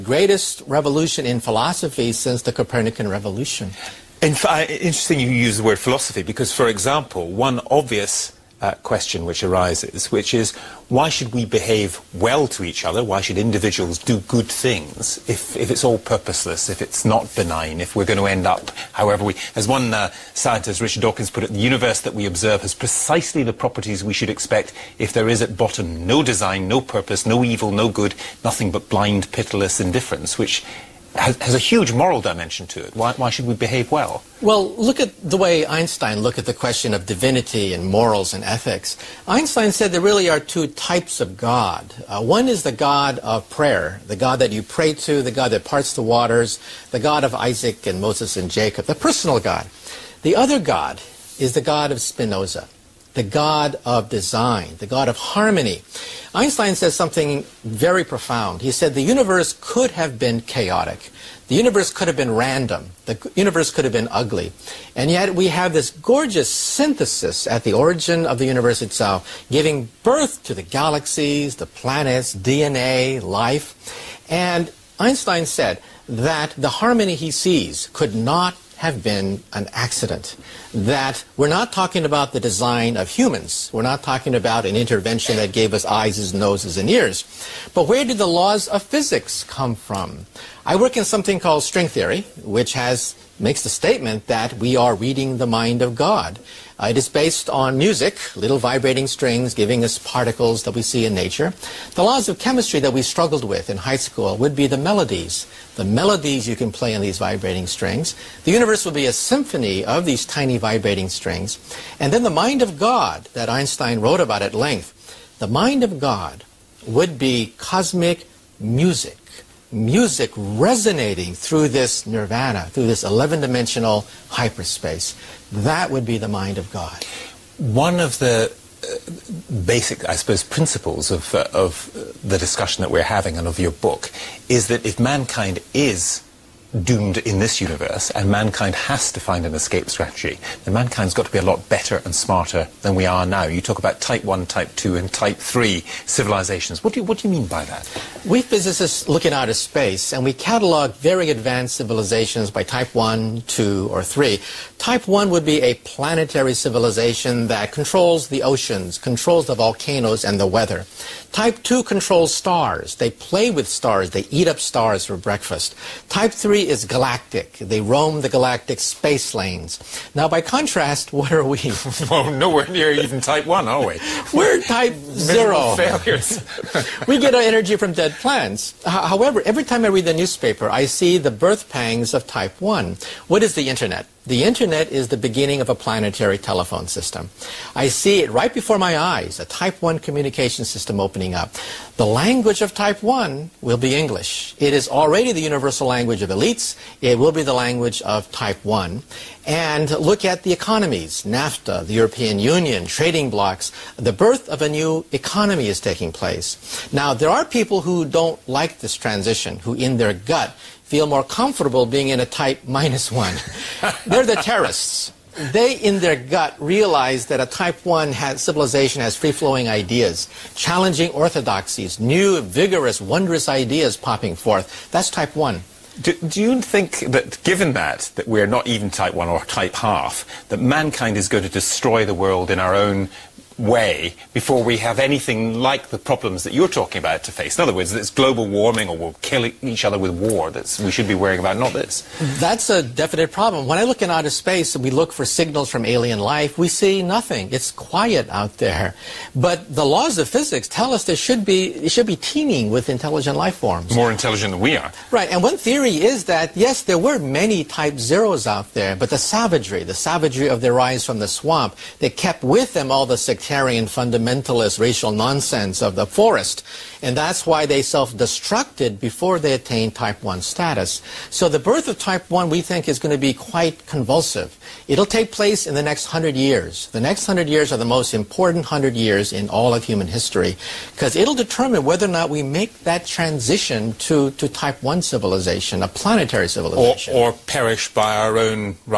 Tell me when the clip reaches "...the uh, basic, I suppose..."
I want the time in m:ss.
2:08.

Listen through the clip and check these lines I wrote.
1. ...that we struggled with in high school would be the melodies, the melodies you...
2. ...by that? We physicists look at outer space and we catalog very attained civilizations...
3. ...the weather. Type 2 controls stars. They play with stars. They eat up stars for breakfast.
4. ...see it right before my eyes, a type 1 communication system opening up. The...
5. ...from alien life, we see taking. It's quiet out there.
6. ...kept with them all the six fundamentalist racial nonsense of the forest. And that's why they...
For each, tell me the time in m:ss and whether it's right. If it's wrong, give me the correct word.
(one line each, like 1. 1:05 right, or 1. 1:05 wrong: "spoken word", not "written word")
1. 1:42 right
2. 2:27 wrong: "advanced", not "attained"
3. 2:40 right
4. 3:07 right
5. 4:05 wrong: "nothing", not "taking"
6. 4:22 right.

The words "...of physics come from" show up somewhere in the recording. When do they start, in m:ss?
1:28.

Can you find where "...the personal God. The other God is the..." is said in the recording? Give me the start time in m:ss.
0:48.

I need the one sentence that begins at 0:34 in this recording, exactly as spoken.
Well, look at the way Einstein looked at the question of divinity and morals and ethics.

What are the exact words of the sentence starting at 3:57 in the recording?
In other words, it's global warming or we'll kill each other with war that we should be worrying about, not this.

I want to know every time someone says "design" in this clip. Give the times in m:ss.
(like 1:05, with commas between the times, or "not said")
0:26, 0:54, 1:22.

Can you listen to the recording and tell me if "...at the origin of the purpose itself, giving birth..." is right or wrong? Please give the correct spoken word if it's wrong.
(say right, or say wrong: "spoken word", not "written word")
wrong: "universe", not "purpose".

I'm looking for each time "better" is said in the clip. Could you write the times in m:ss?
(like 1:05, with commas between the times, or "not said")
2:21.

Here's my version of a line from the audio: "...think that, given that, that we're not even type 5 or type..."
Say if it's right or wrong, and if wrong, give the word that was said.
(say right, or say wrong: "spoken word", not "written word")
wrong: "1", not "5".